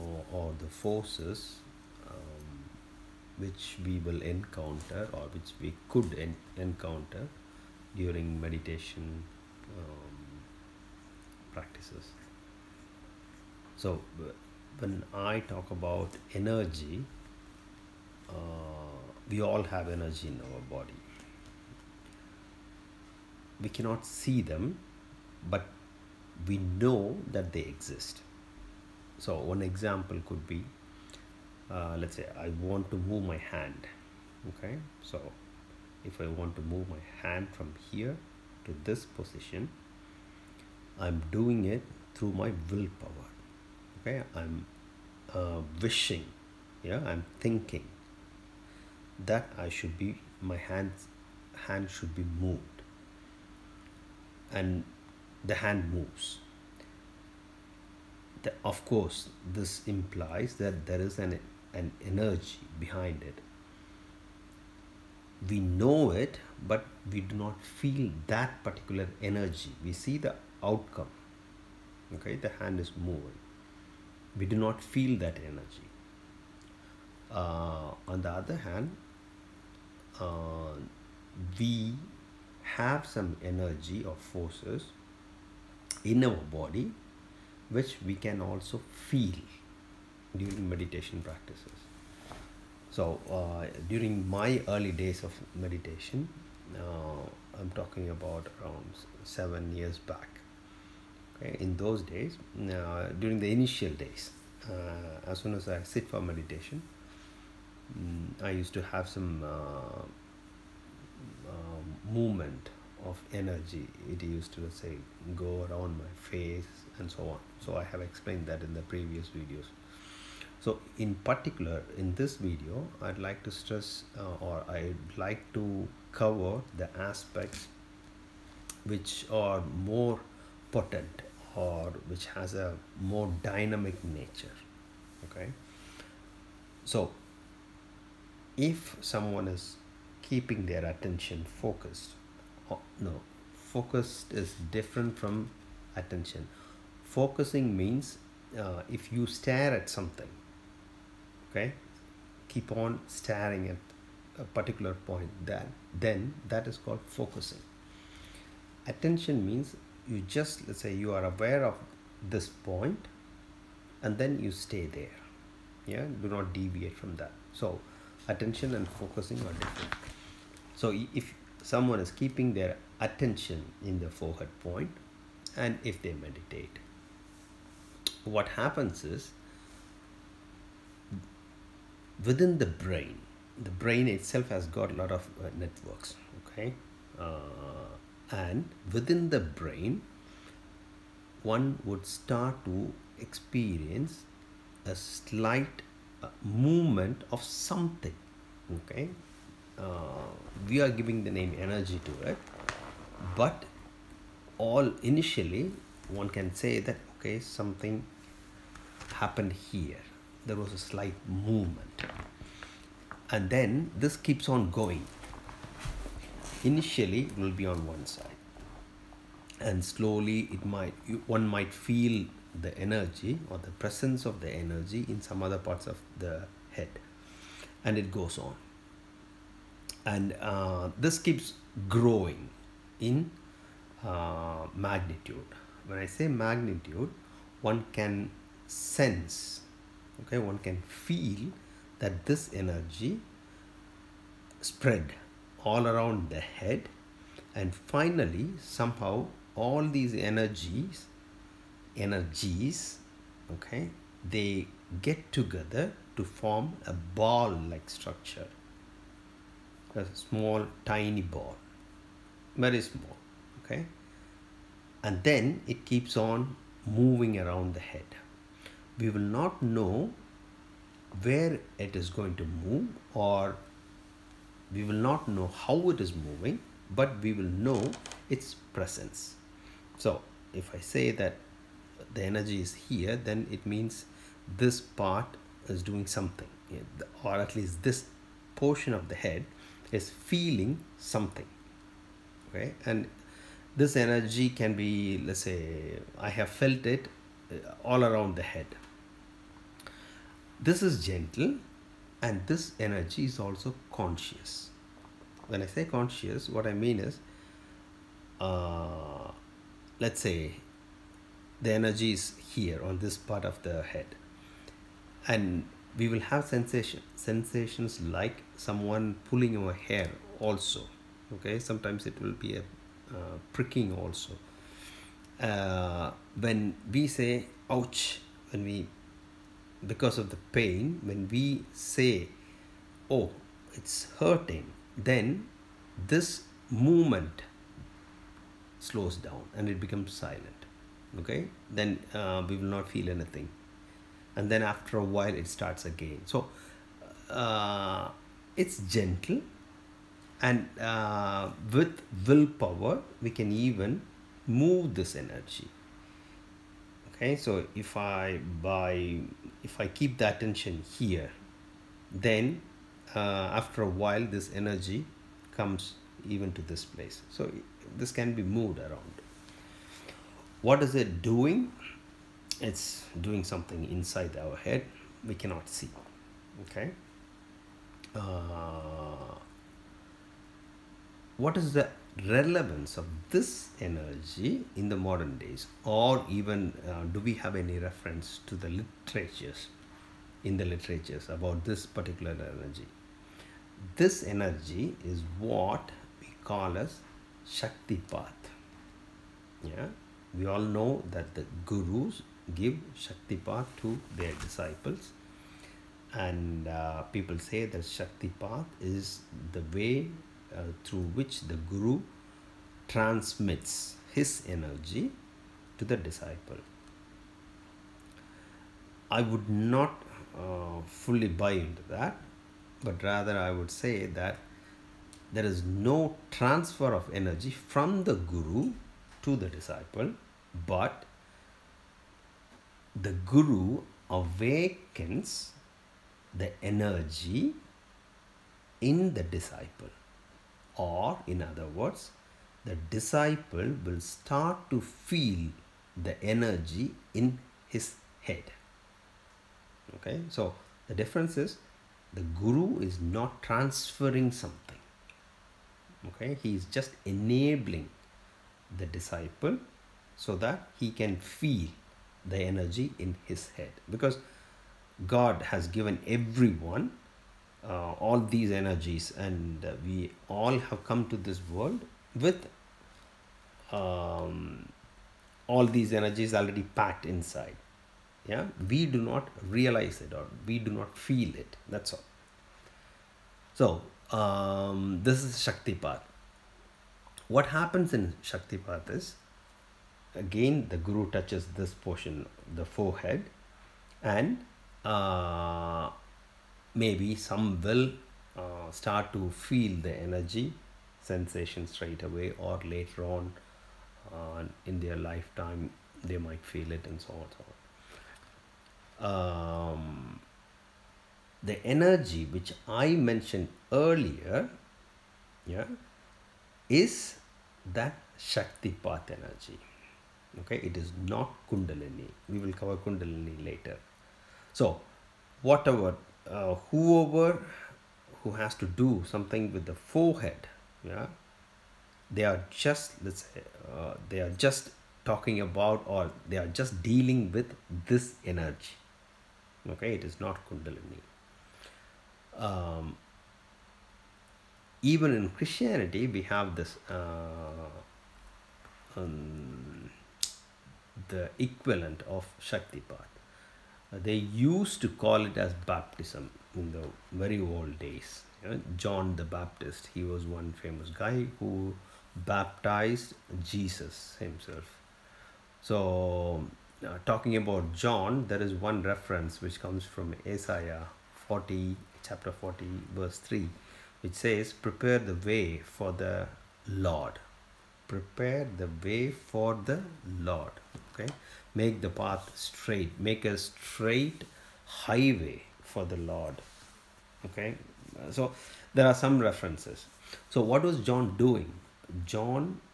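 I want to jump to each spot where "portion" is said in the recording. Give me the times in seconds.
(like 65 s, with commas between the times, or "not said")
288 s, 491 s.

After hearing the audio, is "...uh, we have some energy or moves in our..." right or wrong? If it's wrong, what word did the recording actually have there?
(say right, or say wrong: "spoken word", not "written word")
wrong: "forces", not "moves".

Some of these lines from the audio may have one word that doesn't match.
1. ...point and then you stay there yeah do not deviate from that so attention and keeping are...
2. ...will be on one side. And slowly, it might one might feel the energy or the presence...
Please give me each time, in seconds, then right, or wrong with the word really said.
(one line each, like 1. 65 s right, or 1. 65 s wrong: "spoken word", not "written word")
1. 162 s wrong: "focusing", not "keeping"
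2. 217 s right.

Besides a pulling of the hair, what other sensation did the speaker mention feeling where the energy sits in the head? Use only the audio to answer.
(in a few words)
Pricking.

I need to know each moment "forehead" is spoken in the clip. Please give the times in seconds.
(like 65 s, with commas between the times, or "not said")
174 s, 492 s, 529 s.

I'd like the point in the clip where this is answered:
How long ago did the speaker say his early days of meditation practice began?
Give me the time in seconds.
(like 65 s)
99 s.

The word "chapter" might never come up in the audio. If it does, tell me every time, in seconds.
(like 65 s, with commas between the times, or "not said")
572 s.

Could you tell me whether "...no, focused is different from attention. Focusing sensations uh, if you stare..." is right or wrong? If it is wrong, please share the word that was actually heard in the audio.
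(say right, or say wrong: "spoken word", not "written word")
wrong: "means", not "sensations".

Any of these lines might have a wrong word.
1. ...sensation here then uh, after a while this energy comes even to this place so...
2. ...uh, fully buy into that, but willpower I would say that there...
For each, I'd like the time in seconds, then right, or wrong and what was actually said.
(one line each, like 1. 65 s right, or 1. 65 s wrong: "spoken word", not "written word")
1. 360 s wrong: "attention", not "sensation"
2. 420 s wrong: "rather", not "willpower".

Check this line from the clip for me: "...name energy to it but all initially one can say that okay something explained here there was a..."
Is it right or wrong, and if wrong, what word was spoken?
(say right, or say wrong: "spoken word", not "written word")
wrong: "happened", not "explained".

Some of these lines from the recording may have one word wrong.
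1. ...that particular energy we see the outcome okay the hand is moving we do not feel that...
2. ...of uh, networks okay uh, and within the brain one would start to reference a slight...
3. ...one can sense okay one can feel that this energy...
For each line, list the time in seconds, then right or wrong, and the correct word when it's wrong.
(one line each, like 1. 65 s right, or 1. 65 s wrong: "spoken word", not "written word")
1. 68 s right
2. 185 s wrong: "experience", not "reference"
3. 237 s right.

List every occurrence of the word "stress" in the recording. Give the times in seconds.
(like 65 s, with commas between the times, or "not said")
123 s.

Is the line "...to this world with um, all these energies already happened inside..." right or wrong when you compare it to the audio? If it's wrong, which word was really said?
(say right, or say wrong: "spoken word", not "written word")
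wrong: "packed", not "happened".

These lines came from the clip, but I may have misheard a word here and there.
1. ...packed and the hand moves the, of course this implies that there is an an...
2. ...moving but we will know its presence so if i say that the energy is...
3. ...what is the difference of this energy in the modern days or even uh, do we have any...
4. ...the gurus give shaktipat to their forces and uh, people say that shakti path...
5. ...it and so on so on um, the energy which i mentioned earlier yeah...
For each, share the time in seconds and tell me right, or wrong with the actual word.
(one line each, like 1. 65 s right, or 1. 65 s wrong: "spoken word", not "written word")
1. 52 s wrong: "moved", not "packed"
2. 276 s right
3. 381 s wrong: "relevance", not "difference"
4. 401 s wrong: "disciples", not "forces"
5. 506 s right.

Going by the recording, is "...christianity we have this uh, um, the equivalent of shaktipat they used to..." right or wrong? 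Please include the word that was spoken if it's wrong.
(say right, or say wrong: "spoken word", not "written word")
right.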